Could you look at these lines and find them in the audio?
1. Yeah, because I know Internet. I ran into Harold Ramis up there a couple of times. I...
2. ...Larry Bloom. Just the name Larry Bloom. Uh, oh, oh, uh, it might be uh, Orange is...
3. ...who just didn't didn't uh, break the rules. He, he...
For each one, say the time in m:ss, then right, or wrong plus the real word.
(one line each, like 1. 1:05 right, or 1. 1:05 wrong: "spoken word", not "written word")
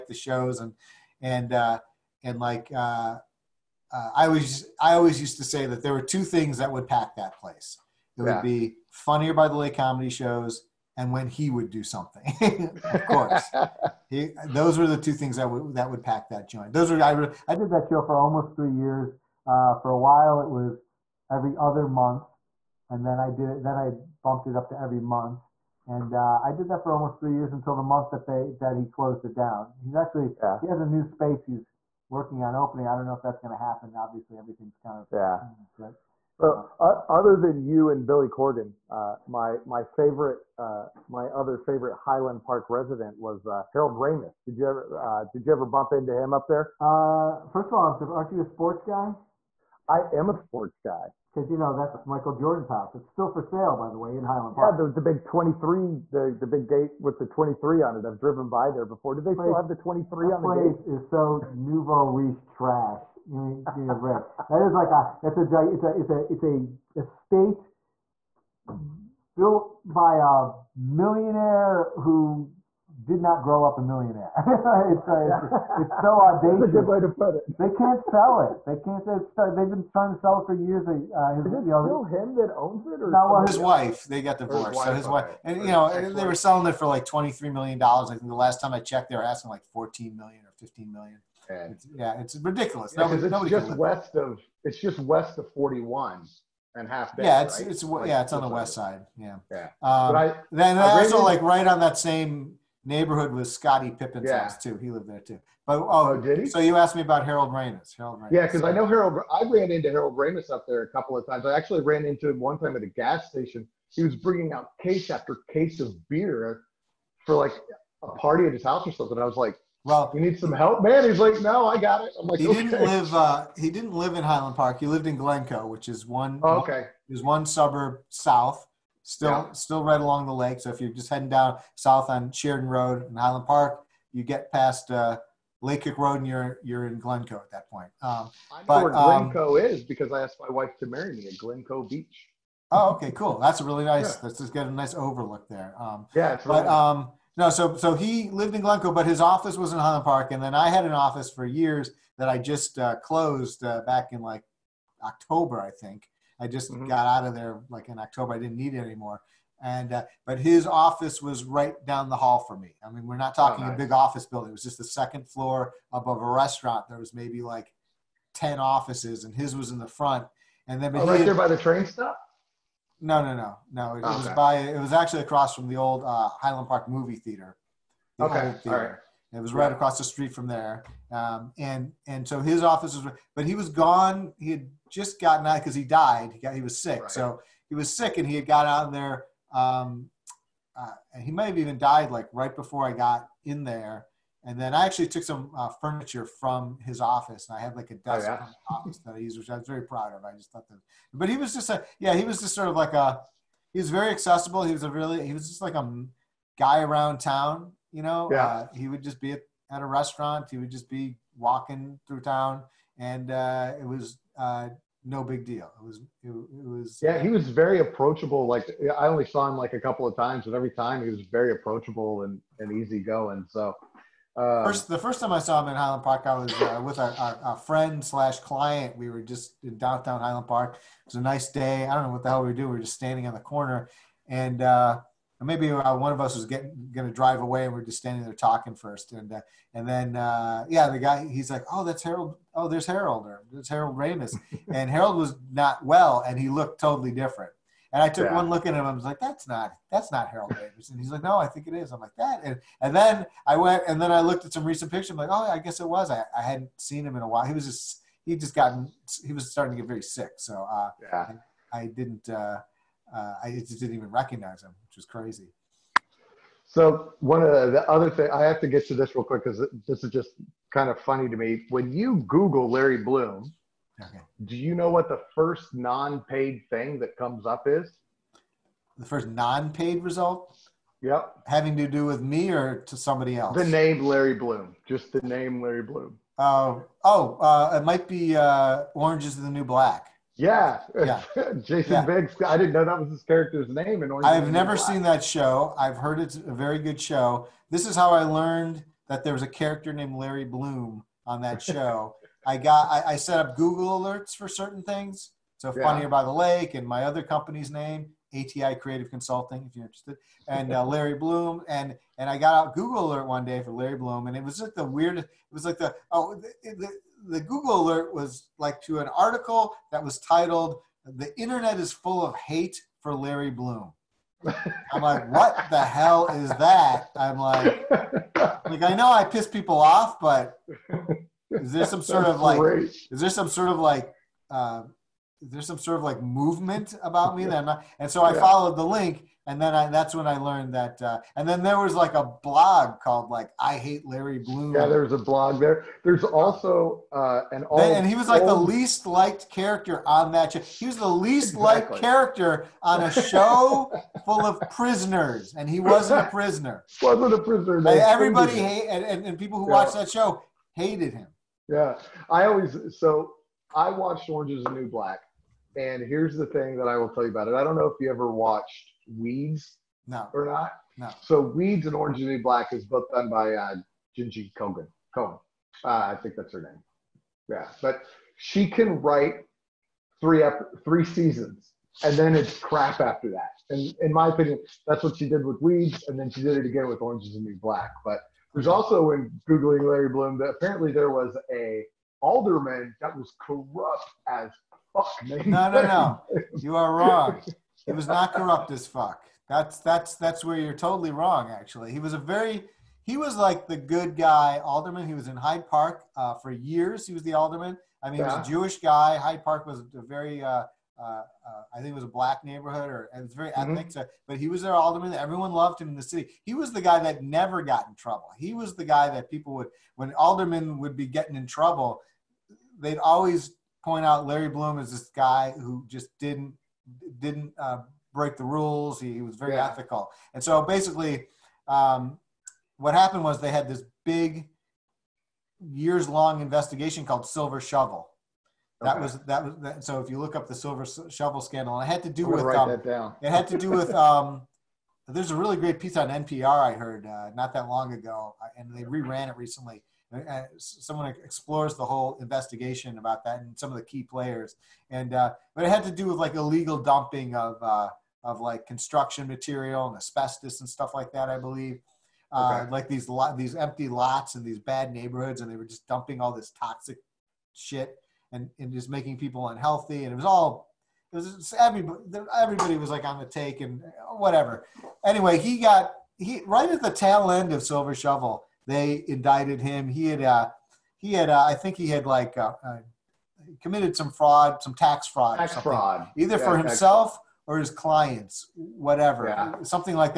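1. 1:48 wrong: "Harold", not "Internet"
2. 4:44 right
3. 7:05 right.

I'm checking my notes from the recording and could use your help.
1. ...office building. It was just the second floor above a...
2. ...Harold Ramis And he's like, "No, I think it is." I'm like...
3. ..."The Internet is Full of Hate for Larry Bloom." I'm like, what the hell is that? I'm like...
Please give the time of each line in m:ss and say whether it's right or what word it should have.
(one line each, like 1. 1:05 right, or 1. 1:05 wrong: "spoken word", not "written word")
1. 2:43 right
2. 4:10 right
3. 5:21 right.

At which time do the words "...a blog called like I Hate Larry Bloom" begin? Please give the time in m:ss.
5:42.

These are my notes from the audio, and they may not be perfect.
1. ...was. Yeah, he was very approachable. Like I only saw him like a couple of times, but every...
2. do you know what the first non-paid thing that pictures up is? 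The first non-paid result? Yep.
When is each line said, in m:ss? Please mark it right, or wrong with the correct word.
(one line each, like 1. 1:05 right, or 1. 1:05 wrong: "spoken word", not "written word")
1. 3:36 right
2. 4:34 wrong: "comes", not "pictures".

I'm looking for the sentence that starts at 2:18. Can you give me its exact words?
Um, I know but, where um, Glencoe um, is because I asked my wife to marry me at Glencoe Beach.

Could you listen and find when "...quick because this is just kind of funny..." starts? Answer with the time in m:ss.
4:29.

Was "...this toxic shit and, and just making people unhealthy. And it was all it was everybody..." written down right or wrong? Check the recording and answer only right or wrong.
right.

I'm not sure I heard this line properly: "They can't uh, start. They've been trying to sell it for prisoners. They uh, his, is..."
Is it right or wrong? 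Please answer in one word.
wrong.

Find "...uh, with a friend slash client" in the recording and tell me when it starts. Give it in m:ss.
3:46.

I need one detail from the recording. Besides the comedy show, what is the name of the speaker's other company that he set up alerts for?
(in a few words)
ATI Creative Consulting.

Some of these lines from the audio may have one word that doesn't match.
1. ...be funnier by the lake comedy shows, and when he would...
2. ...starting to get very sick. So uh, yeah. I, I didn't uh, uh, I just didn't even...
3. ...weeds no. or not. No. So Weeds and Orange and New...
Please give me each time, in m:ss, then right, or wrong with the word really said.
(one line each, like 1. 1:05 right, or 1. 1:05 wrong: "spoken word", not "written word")
1. 0:08 right
2. 4:19 right
3. 6:09 right.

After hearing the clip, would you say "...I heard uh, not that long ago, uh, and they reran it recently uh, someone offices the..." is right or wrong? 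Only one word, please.
wrong.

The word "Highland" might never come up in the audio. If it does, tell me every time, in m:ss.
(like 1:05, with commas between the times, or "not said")
0:41, 0:54, 2:04, 2:13, 2:29, 2:56, 3:45, 3:50.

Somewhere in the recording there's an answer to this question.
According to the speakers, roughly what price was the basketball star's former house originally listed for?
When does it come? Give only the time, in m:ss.
1:27.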